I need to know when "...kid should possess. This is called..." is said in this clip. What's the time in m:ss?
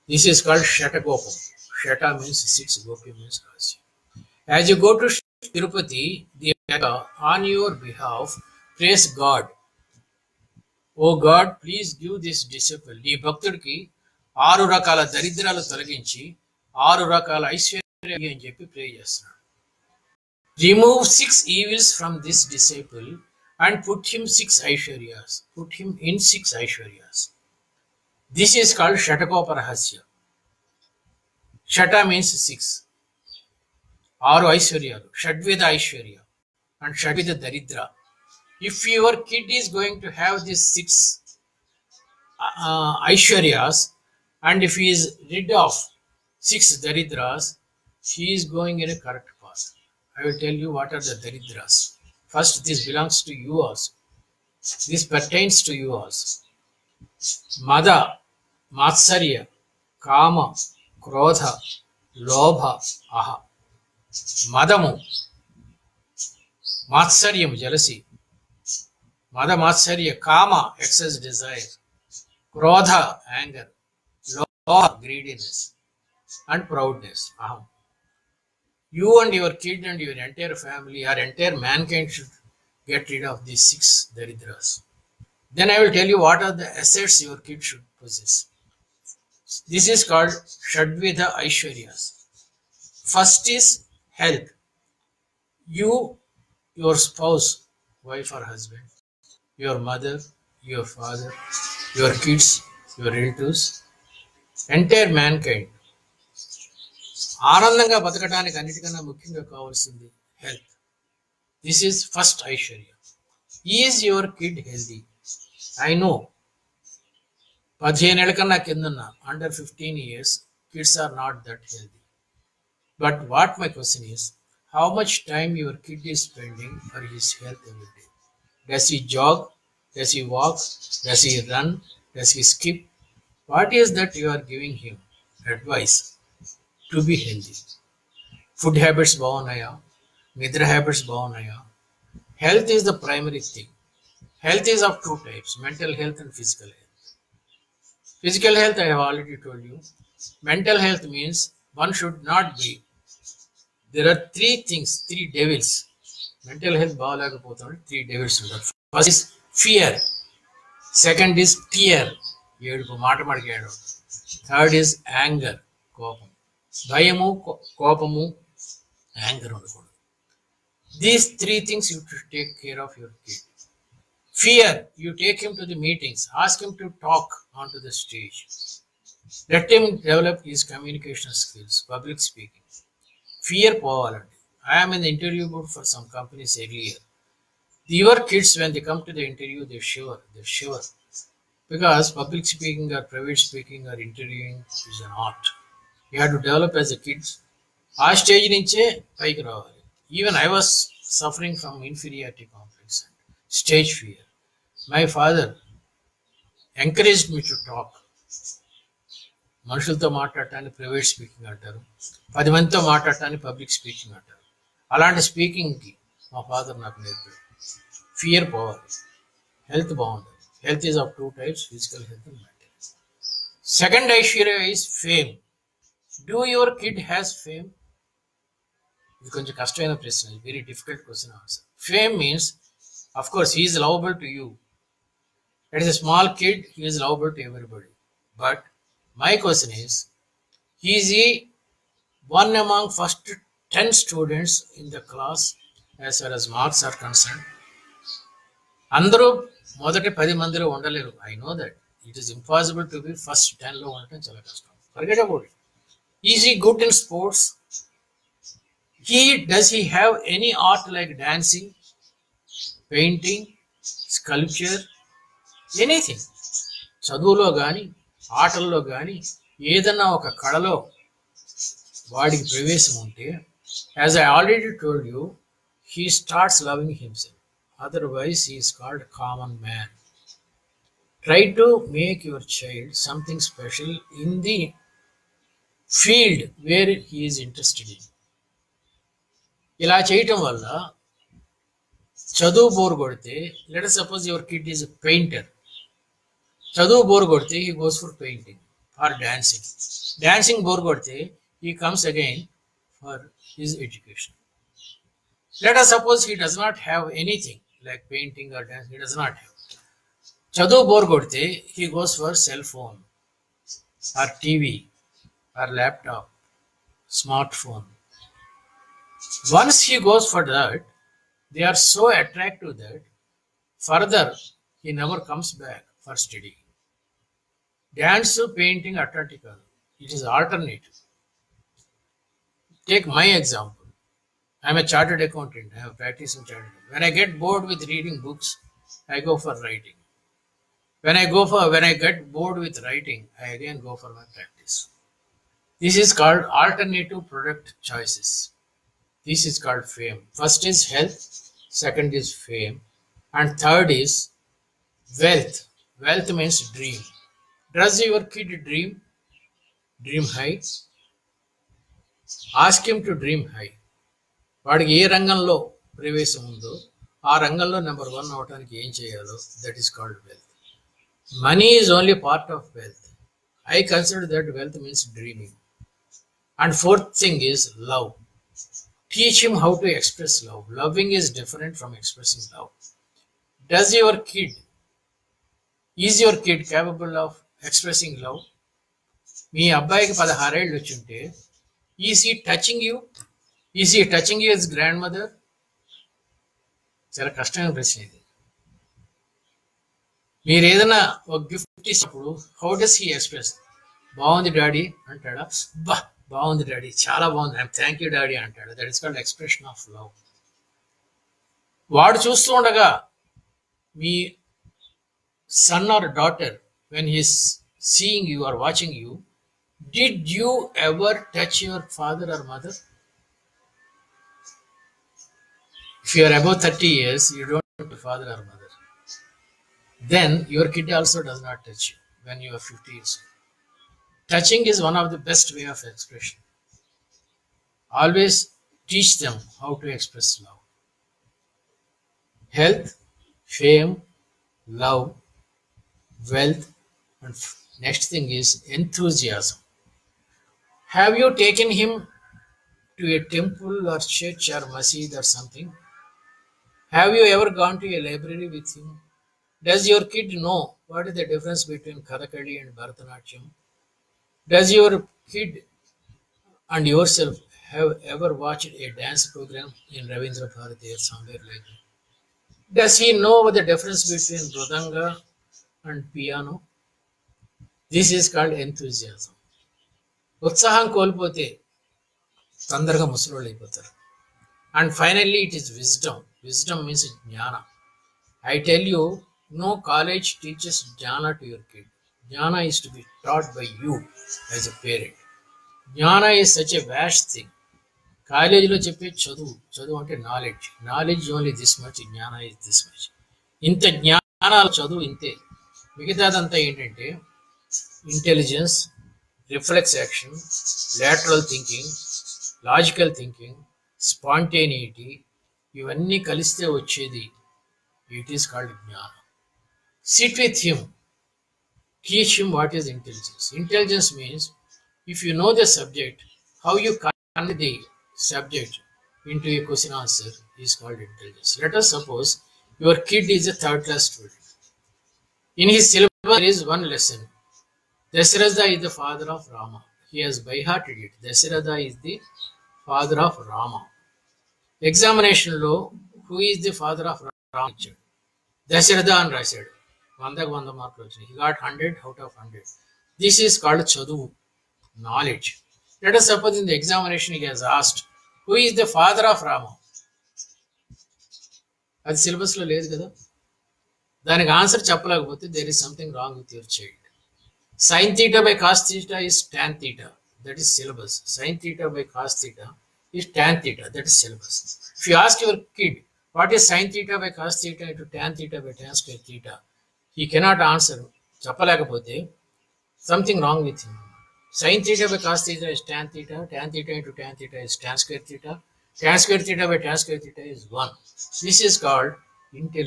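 1:27.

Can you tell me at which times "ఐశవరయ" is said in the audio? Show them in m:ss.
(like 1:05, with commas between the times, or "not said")
1:52, 3:44.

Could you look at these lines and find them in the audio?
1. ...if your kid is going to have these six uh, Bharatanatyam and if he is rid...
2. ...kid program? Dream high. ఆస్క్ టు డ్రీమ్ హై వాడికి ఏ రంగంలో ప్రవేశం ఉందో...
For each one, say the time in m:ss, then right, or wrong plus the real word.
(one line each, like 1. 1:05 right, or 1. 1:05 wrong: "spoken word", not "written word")
1. 0:38 wrong: "Aishwaryas", not "Bharatanatyam"
2. 5:58 wrong: "dream", not "program".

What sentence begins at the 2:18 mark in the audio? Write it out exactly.
Food habits bhavanaya, nidra habits bhavanaya.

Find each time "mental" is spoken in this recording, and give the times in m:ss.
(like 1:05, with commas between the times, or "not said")
2:25, 2:30, 2:36.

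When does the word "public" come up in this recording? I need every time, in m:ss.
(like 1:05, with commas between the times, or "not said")
3:01, 3:12.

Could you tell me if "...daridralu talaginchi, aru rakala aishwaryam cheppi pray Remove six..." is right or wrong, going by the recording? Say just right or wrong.
right.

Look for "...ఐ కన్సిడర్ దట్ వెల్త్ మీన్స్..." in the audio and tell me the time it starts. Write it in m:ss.
6:13.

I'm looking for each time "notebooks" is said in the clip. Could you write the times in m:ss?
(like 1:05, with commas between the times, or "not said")
not said.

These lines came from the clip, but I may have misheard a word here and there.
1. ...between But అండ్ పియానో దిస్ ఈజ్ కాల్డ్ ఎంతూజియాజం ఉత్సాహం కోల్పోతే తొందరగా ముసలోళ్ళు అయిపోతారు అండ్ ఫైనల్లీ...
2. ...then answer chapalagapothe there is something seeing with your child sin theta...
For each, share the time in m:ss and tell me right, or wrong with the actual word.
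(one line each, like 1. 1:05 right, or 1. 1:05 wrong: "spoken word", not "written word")
1. 7:54 wrong: "Mridanga", not "But"
2. 9:24 wrong: "wrong", not "seeing".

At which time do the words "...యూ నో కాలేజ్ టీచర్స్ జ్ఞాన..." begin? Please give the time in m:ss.
8:08.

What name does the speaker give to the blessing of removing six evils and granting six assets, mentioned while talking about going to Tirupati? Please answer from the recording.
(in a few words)
Shatakoparahasya.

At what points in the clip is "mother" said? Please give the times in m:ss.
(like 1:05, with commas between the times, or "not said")
1:39, 7:02, 7:08.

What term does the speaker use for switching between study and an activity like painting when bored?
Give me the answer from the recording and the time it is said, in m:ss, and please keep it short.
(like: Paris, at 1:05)
Alternative product choices, at 5:46.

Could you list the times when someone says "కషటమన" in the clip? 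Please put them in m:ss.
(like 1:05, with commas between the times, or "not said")
3:49, 6:37.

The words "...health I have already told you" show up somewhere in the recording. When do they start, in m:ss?
2:28.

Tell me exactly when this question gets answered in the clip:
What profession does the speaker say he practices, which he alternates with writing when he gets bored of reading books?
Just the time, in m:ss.
5:34.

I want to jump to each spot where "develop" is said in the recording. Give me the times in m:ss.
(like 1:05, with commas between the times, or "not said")
2:59, 3:16.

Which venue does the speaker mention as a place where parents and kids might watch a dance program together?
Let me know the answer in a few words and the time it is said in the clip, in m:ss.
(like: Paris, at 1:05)
Ravindra Bharati, at 7:50.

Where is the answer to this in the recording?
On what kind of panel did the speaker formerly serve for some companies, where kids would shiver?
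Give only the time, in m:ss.
3:04.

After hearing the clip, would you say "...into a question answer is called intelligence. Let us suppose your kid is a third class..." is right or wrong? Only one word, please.
right.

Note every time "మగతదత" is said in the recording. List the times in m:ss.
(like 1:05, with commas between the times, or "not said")
8:26.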